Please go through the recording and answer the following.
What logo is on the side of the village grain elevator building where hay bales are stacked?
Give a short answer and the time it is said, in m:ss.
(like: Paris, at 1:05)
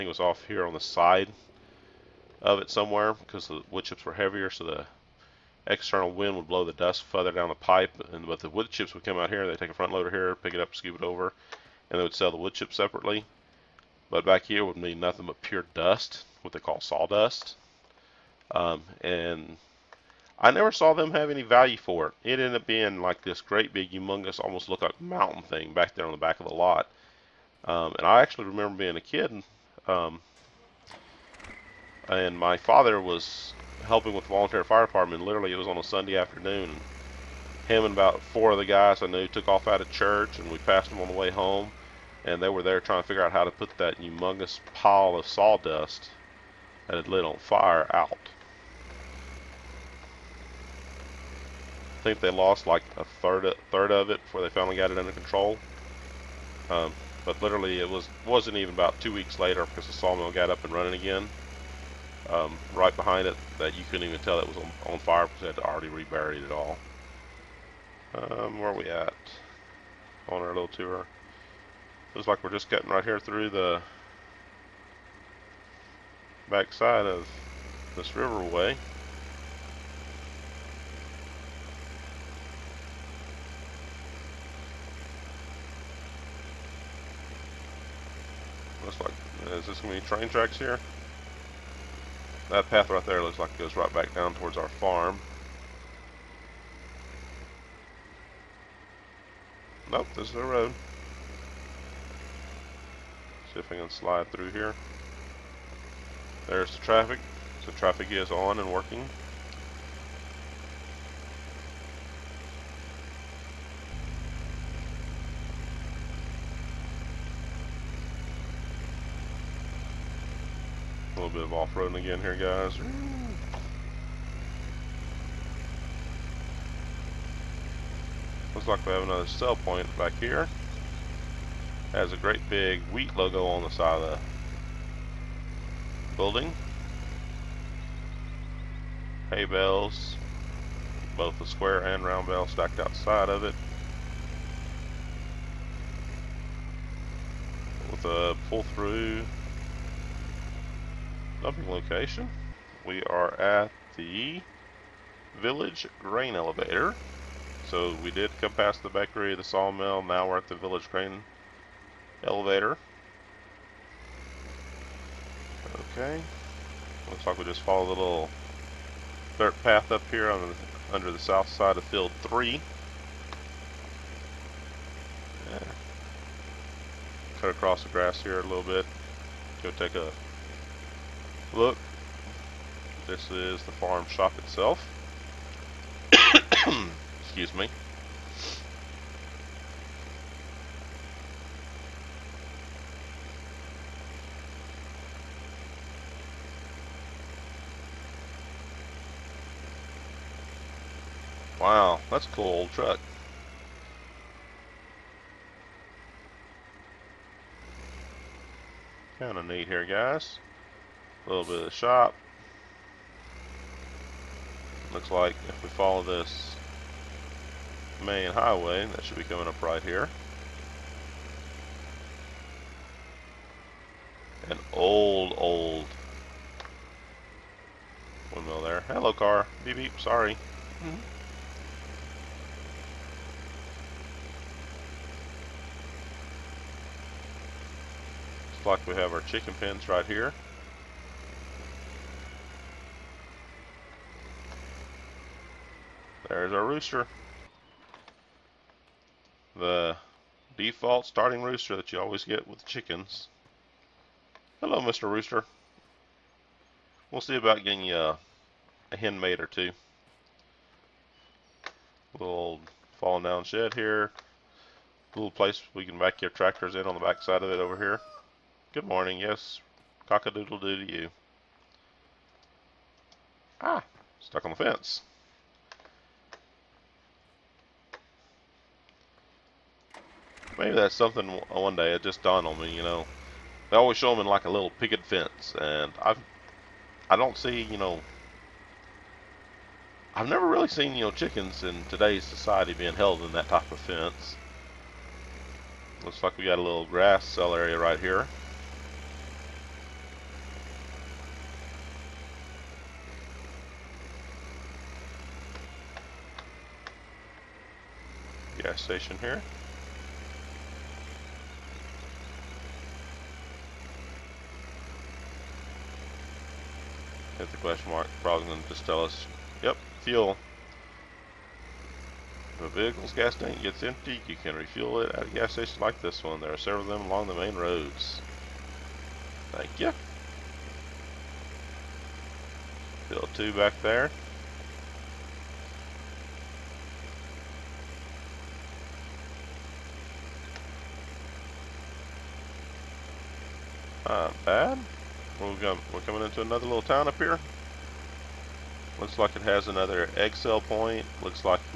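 wheat, at 2:12.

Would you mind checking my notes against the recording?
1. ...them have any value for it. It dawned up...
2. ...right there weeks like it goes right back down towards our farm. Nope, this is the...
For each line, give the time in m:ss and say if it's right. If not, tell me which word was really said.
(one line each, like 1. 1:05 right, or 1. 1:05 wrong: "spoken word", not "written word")
1. 0:20 wrong: "ended", not "dawned"
2. 1:32 wrong: "looks", not "weeks".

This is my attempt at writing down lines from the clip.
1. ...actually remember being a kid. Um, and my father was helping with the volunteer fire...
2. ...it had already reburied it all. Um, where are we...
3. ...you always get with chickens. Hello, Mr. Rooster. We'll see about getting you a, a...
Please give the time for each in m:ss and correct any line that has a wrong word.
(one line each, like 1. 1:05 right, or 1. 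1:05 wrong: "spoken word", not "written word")
1. 0:28 right
2. 1:05 right
3. 4:11 right.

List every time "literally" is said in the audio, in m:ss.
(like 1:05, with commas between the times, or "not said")
0:35, 0:57.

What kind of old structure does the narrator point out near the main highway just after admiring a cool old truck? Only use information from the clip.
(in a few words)
windmill.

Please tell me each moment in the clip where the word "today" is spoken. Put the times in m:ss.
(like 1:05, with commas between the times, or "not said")
4:51.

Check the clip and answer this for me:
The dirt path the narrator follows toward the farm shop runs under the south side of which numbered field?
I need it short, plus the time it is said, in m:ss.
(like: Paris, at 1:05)
field 3, at 2:51.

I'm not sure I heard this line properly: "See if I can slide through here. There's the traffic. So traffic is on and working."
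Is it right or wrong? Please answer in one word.
right.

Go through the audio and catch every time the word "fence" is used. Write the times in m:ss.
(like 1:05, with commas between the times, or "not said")
4:34, 4:45, 4:53.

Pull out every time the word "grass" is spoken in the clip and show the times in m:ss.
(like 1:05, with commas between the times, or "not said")
2:57, 4:56.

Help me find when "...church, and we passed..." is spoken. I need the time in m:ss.
0:39.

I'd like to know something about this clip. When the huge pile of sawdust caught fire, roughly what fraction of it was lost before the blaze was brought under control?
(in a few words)
a third.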